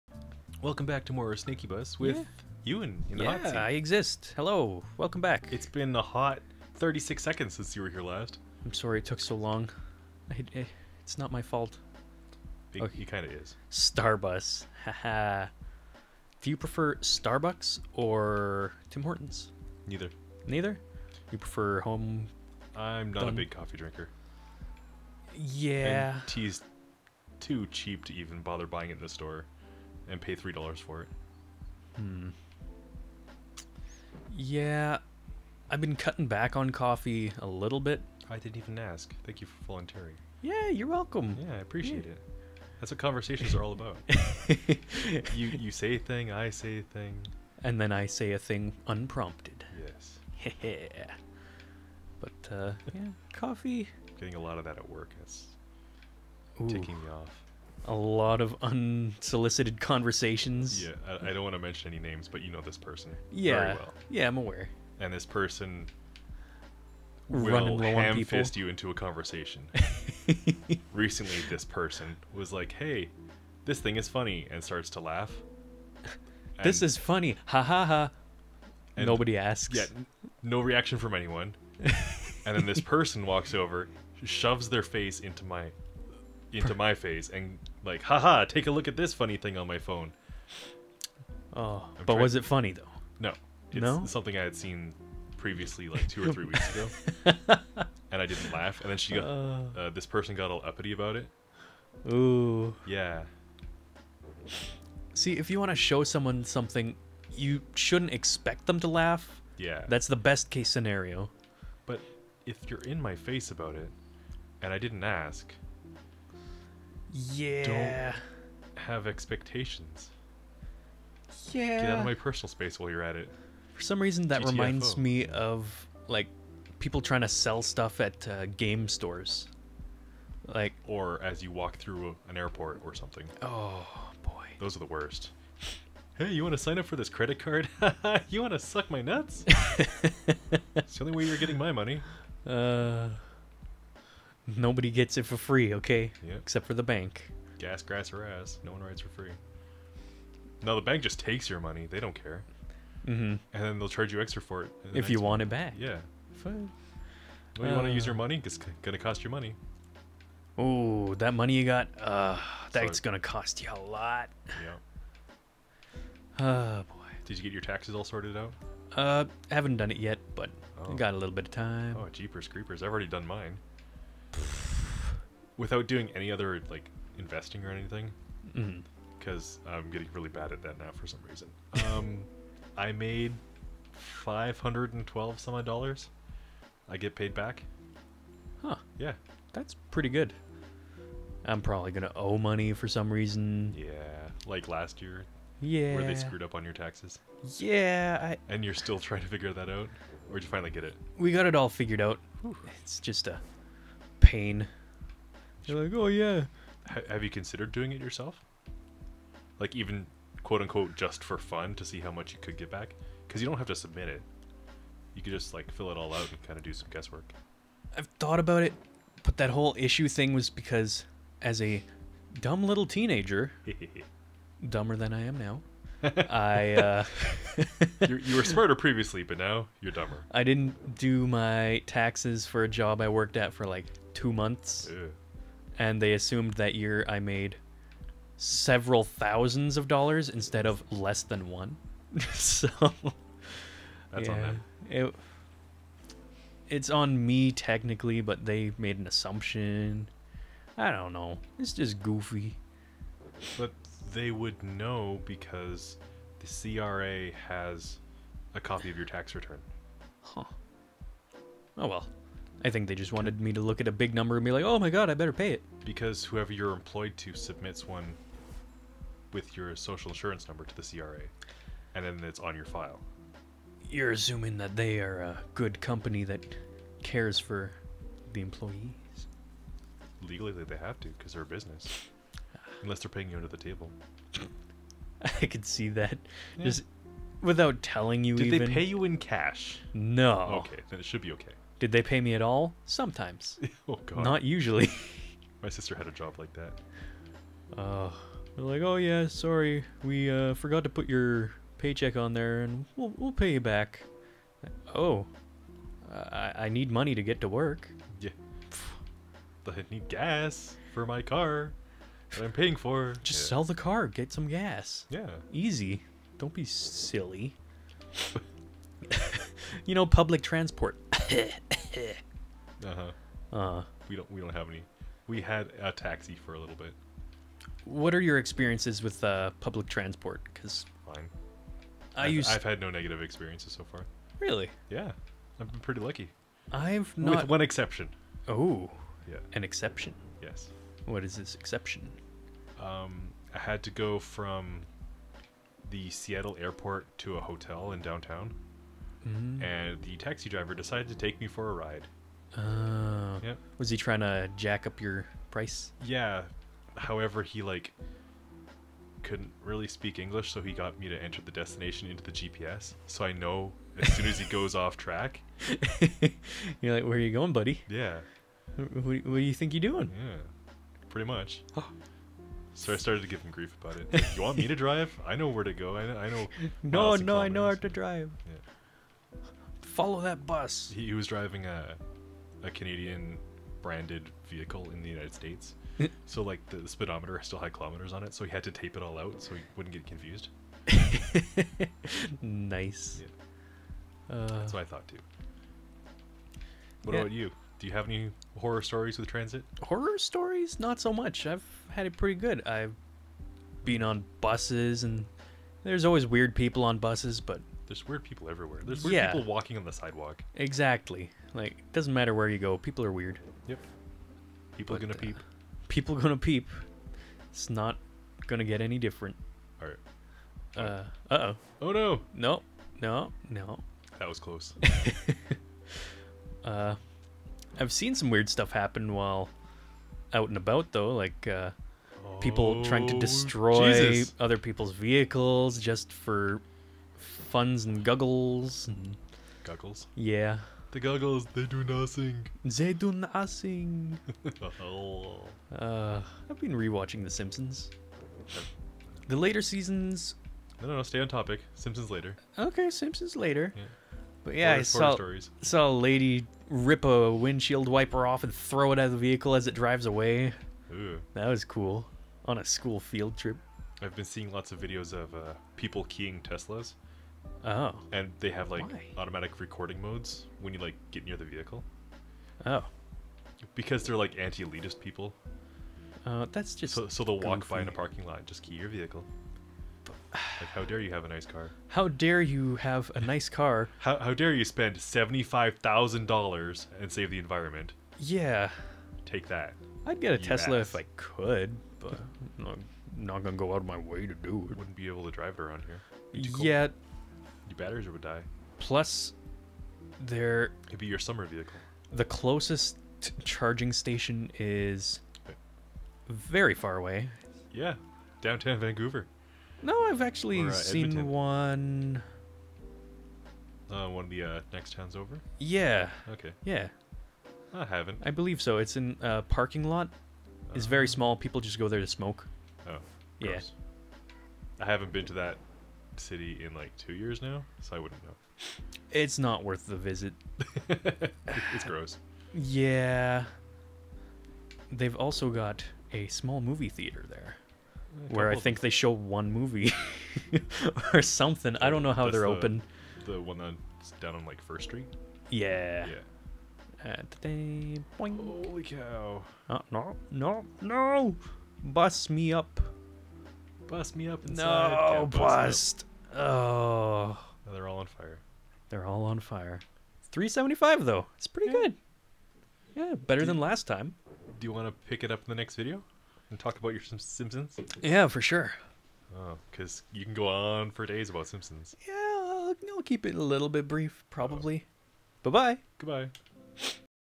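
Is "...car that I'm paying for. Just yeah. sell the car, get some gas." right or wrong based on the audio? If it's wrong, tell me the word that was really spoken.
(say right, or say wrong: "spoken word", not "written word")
right.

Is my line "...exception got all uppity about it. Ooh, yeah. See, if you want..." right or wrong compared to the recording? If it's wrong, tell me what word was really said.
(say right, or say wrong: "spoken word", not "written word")
wrong: "person", not "exception".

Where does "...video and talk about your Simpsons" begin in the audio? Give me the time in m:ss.
9:25.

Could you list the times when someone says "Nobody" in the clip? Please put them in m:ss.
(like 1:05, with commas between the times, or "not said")
1:19, 2:24.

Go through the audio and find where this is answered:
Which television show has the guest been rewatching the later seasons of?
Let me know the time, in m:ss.
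7:27.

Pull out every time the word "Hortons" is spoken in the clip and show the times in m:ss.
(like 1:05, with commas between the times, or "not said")
0:19.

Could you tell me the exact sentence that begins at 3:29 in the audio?
Like even quote unquote just for fun to see how much you could get back?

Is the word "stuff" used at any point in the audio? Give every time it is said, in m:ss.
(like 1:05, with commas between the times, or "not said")
2:07, 7:08.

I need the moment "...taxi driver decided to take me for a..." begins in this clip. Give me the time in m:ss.
5:50.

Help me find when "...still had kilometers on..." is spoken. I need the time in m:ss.
6:27.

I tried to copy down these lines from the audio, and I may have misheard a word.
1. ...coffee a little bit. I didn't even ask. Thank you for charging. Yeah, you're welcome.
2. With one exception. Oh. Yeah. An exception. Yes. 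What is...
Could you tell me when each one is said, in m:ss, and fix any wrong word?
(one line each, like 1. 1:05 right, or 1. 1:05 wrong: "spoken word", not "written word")
1. 0:36 wrong: "volunteering", not "charging"
2. 5:37 right.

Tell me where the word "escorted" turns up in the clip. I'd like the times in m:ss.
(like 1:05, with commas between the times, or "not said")
not said.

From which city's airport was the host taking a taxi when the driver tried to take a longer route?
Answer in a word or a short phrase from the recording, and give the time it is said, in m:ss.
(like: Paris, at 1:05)
Seattle, at 5:46.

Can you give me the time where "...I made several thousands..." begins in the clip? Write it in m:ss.
3:57.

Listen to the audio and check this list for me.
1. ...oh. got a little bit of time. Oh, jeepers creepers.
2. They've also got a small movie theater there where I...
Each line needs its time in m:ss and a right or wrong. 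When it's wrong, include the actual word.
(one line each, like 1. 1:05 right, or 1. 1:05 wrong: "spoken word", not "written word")
1. 2:50 right
2. 8:54 right.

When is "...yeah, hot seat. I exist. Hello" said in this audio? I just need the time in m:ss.
0:03.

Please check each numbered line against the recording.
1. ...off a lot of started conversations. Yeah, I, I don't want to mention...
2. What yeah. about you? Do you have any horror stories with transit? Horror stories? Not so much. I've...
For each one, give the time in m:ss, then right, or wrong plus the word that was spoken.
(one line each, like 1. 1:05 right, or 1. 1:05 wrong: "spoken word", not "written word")
1. 0:57 wrong: "unsolicited", not "started"
2. 6:37 right.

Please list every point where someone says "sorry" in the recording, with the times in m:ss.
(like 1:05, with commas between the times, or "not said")
0:08, 4:59.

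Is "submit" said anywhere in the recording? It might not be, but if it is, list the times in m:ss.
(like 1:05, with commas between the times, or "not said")
3:33, 4:27.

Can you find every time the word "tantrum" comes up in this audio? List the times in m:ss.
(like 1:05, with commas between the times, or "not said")
not said.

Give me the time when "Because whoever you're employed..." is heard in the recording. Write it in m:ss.
4:25.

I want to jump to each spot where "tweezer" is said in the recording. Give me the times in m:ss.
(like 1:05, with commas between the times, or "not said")
not said.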